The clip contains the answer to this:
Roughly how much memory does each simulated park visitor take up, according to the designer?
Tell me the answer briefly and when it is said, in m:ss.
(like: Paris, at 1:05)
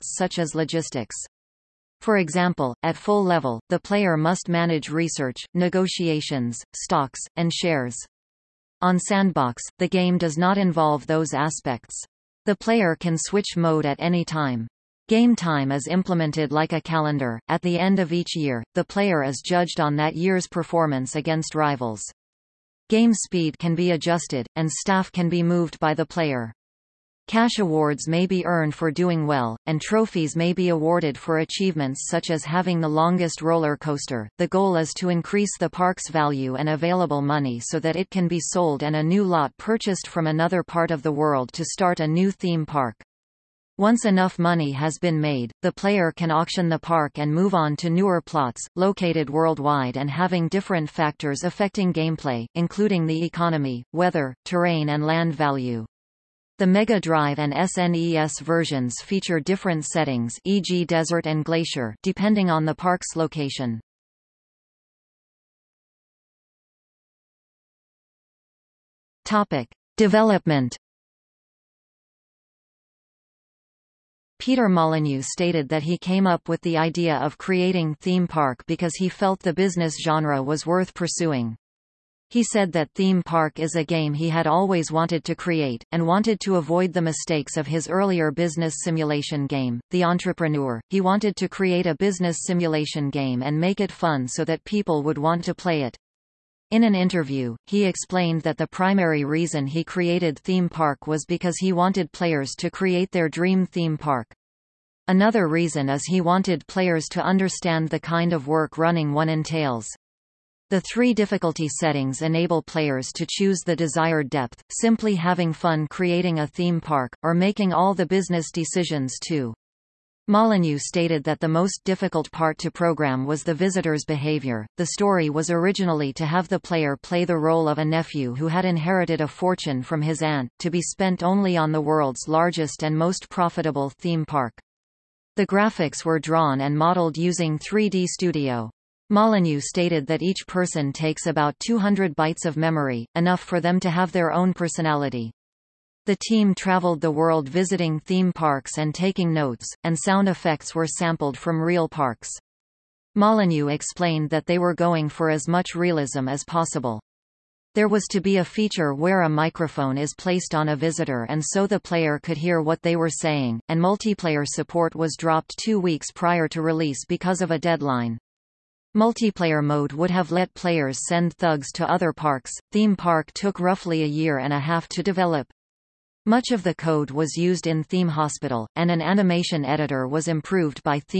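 200 bytes, at 2:21.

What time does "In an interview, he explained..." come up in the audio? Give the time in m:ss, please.
1:36.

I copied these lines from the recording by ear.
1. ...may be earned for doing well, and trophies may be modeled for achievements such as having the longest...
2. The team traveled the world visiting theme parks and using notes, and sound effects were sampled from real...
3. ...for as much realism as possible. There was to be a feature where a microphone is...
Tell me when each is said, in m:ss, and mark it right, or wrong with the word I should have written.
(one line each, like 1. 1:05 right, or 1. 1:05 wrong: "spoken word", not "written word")
1. 0:28 wrong: "awarded", not "modeled"
2. 2:26 wrong: "taking", not "using"
3. 2:35 right.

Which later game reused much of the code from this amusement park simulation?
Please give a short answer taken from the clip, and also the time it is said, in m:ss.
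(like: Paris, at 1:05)
Theme Hospital, at 2:57.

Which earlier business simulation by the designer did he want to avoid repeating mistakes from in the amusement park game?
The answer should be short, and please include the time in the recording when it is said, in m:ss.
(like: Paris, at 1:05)
The Entrepreneur, at 1:29.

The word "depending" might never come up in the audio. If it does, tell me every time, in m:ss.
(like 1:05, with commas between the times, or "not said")
1:02.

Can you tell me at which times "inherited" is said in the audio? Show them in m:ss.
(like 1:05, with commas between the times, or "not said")
2:08.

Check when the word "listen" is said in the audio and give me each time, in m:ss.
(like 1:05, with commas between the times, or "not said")
not said.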